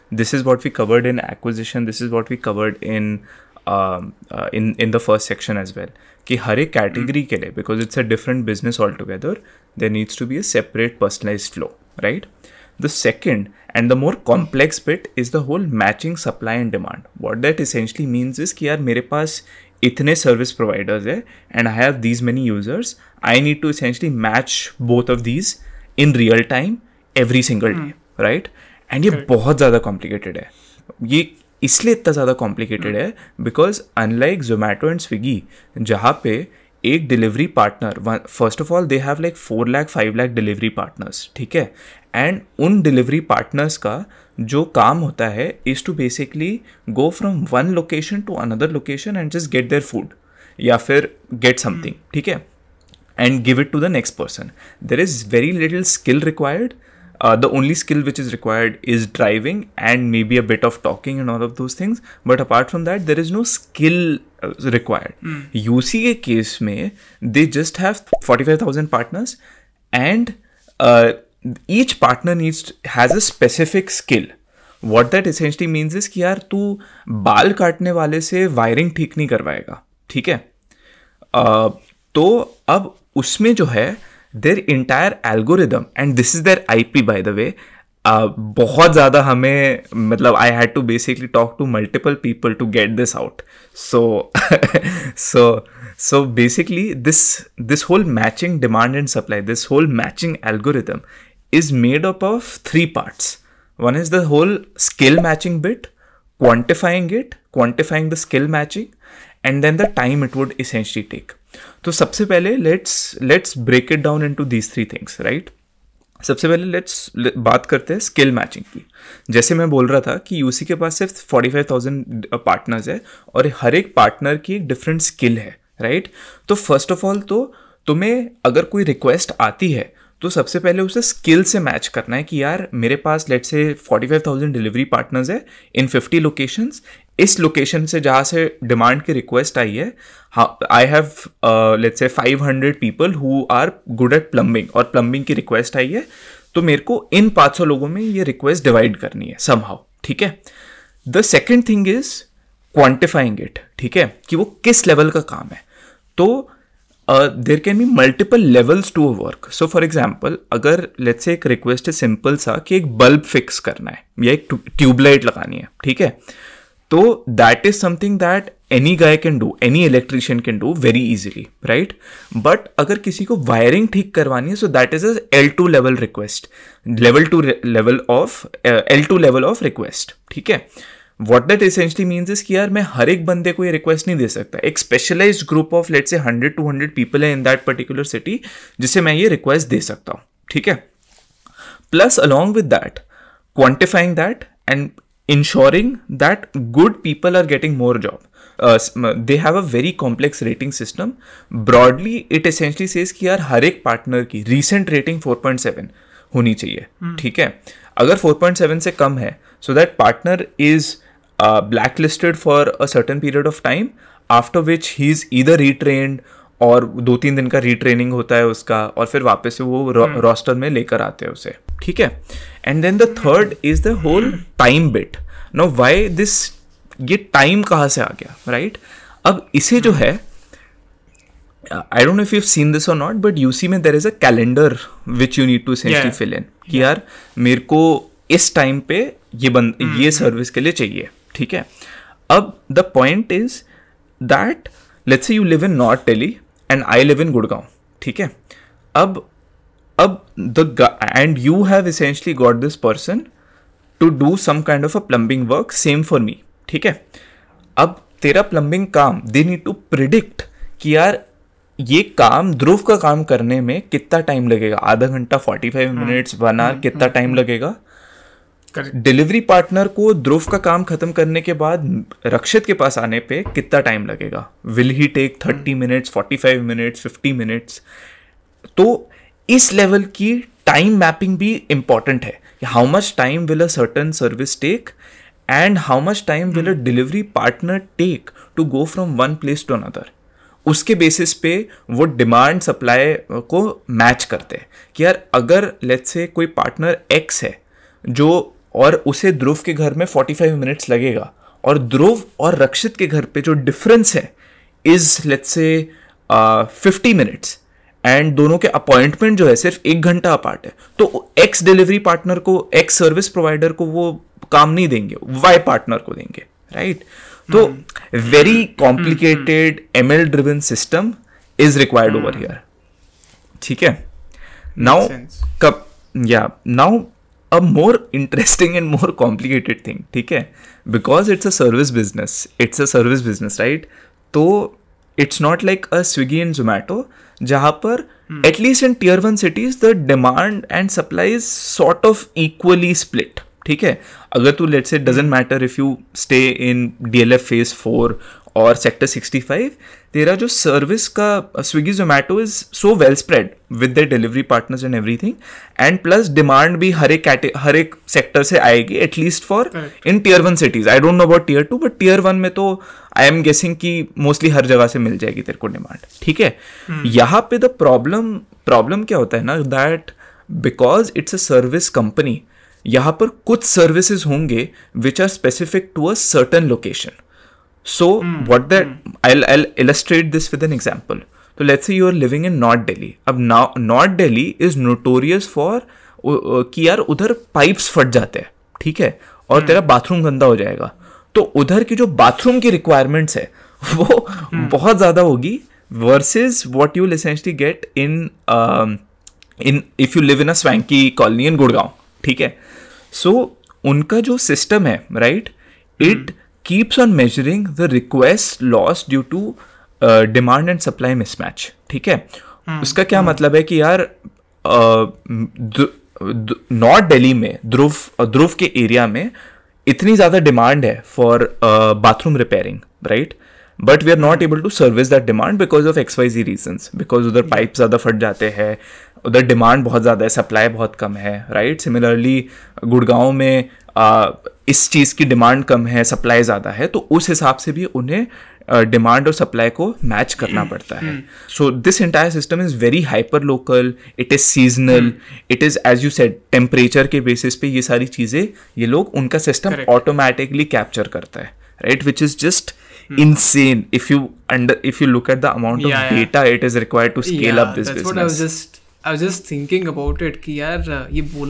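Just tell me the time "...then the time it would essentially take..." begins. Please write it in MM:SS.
01:49.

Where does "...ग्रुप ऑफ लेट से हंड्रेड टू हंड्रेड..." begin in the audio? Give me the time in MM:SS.
03:05.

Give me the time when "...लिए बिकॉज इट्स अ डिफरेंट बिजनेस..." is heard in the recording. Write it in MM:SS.
00:07.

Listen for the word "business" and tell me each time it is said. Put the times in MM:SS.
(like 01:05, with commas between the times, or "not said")
07:38.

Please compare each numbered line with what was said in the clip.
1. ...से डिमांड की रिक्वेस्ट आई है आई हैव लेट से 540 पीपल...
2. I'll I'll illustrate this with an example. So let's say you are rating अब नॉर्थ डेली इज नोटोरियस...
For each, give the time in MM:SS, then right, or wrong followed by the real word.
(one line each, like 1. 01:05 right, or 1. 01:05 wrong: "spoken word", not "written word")
1. 02:18 wrong: "500", not "540"
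2. 06:19 wrong: "living", not "rating".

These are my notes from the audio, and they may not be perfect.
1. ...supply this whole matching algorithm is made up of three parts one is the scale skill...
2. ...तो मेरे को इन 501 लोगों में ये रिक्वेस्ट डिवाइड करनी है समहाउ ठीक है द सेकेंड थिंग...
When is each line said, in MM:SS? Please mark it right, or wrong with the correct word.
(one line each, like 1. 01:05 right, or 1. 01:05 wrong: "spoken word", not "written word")
1. 01:39 wrong: "whole", not "scale"
2. 02:26 wrong: "500", not "501".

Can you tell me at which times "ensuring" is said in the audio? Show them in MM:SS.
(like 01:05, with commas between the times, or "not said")
03:15.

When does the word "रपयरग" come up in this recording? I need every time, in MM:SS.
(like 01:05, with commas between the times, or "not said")
07:02.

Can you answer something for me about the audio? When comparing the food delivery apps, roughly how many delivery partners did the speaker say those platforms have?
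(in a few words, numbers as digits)
4-5 lakh.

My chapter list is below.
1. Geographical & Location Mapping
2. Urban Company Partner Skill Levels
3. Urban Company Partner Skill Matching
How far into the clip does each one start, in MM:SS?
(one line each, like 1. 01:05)
1. 05:27
2. 02:31
3. 01:57.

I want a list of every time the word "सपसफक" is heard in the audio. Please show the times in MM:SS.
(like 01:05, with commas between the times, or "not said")
01:13, 06:15.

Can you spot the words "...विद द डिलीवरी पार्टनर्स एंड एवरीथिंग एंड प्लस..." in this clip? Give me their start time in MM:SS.
05:53.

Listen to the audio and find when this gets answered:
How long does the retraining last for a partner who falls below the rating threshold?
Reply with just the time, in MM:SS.
03:37.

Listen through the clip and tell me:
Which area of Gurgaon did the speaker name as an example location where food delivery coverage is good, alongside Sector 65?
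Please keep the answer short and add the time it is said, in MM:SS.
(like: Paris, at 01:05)
DLF Phase 4, at 05:47.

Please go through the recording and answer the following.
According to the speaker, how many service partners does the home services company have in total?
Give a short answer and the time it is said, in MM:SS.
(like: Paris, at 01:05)
45,000, at 01:08.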